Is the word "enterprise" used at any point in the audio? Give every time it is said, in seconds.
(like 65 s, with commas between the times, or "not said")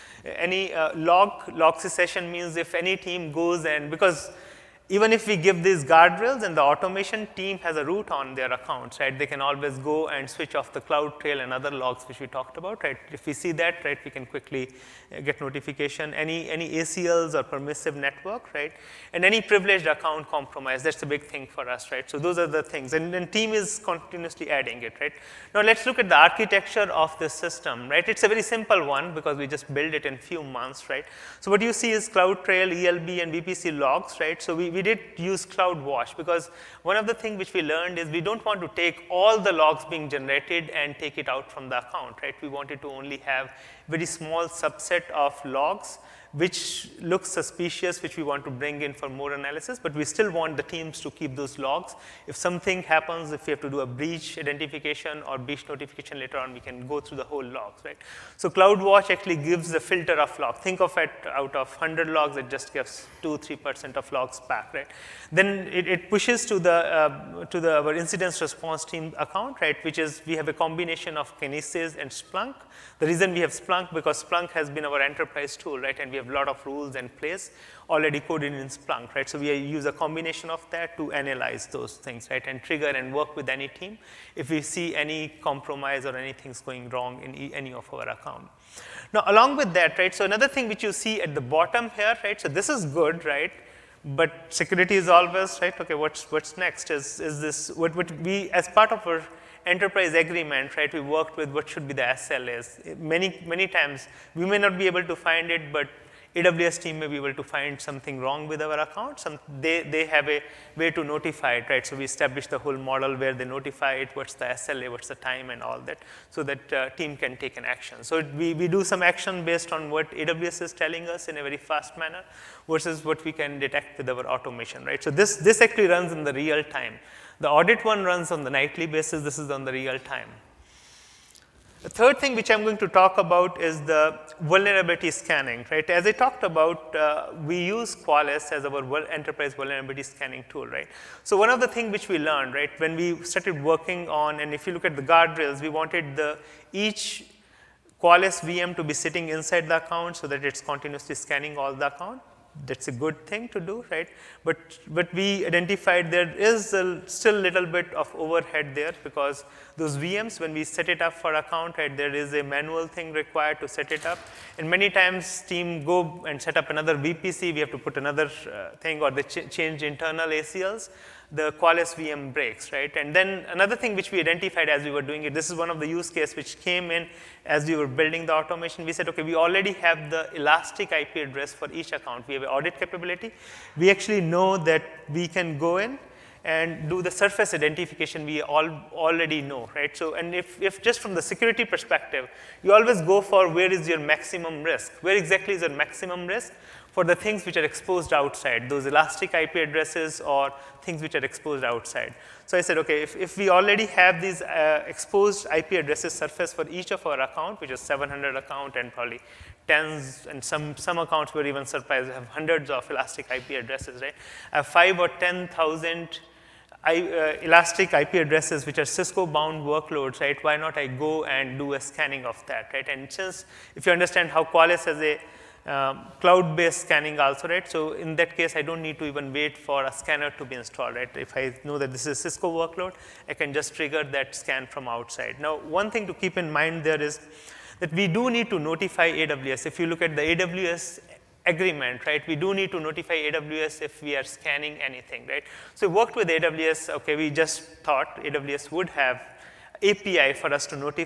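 75 s, 99 s, 139 s.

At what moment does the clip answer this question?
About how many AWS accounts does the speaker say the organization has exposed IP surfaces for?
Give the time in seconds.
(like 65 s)
207 s.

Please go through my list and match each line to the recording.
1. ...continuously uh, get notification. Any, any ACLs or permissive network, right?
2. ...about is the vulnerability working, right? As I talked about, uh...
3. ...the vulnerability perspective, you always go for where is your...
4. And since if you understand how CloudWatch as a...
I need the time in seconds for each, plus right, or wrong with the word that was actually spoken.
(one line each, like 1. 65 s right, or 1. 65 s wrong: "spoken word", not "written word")
1. 14 s wrong: "quickly", not "continuously"
2. 133 s wrong: "scanning", not "working"
3. 191 s wrong: "security", not "vulnerability"
4. 222 s wrong: "Qualys", not "CloudWatch".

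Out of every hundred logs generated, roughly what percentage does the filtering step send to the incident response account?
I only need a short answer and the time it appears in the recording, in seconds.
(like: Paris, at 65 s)
2-3%, at 63 s.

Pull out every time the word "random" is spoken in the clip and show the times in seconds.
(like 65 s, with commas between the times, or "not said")
not said.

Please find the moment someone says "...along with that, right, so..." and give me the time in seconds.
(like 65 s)
89 s.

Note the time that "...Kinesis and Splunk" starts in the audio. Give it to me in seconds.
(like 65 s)
71 s.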